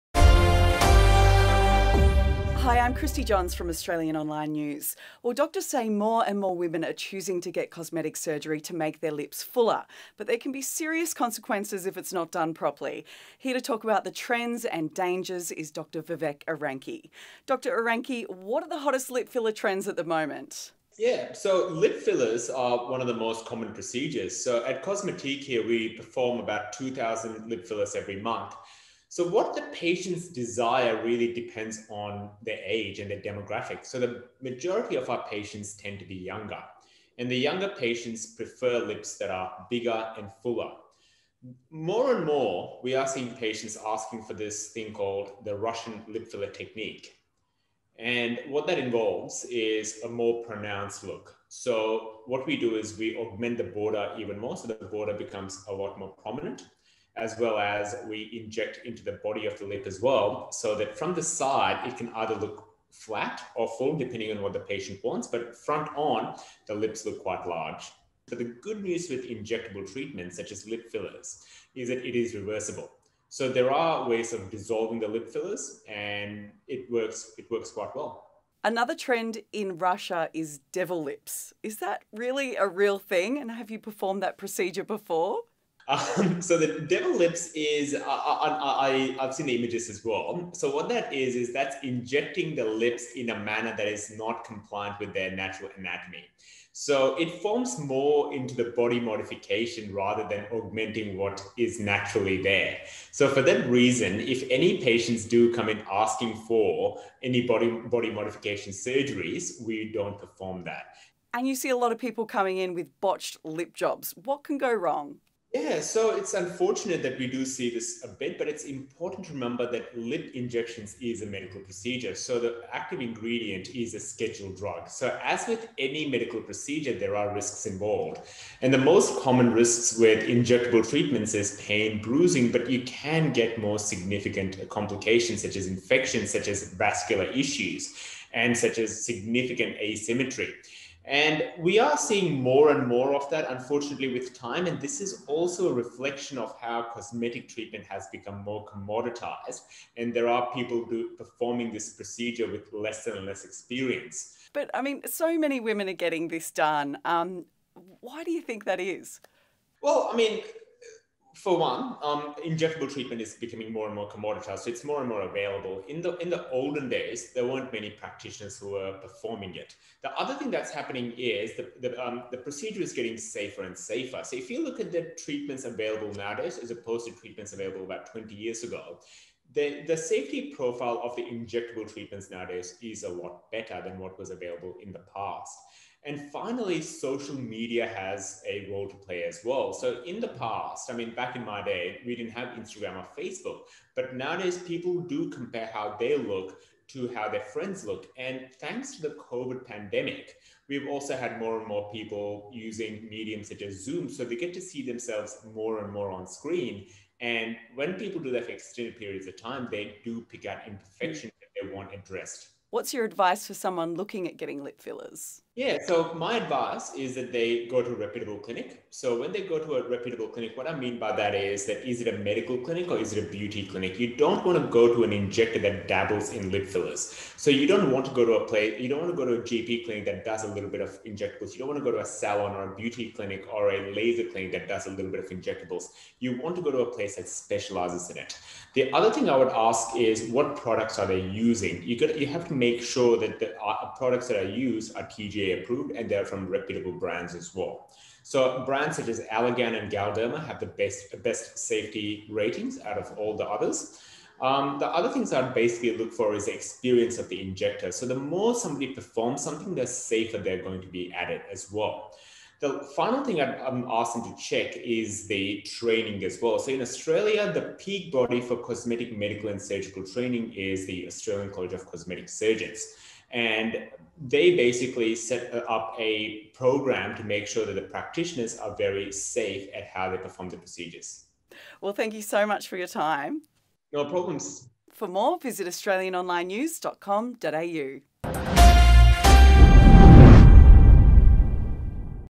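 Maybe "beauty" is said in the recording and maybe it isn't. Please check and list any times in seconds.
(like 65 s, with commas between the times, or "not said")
223 s, 232 s.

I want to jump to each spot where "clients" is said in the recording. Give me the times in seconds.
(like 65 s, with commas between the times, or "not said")
not said.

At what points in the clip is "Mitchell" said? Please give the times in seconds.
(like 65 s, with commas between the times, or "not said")
not said.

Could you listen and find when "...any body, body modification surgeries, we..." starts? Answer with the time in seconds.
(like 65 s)
107 s.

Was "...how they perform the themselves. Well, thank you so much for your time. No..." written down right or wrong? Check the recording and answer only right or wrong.
wrong.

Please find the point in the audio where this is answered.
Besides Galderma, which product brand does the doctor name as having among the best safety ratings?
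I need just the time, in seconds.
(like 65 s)
249 s.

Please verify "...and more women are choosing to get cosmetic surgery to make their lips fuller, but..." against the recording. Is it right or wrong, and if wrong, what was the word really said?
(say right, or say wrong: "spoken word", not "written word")
right.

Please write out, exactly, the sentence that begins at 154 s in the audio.
But I mean, so many women are getting this done.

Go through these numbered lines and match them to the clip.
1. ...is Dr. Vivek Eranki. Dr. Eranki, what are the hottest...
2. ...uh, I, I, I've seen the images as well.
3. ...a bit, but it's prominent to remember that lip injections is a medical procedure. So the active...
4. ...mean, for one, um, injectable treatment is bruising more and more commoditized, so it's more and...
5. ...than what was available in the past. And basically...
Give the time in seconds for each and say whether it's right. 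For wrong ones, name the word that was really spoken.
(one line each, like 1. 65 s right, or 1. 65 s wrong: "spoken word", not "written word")
1. 15 s right
2. 87 s right
3. 118 s wrong: "important", not "prominent"
4. 160 s wrong: "becoming", not "bruising"
5. 183 s wrong: "finally", not "basically".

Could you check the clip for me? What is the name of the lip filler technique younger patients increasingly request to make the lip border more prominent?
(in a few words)
Russian lip filler technique.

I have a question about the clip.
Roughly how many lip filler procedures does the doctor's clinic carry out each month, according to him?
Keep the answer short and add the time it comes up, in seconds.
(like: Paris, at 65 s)
2,000, at 26 s.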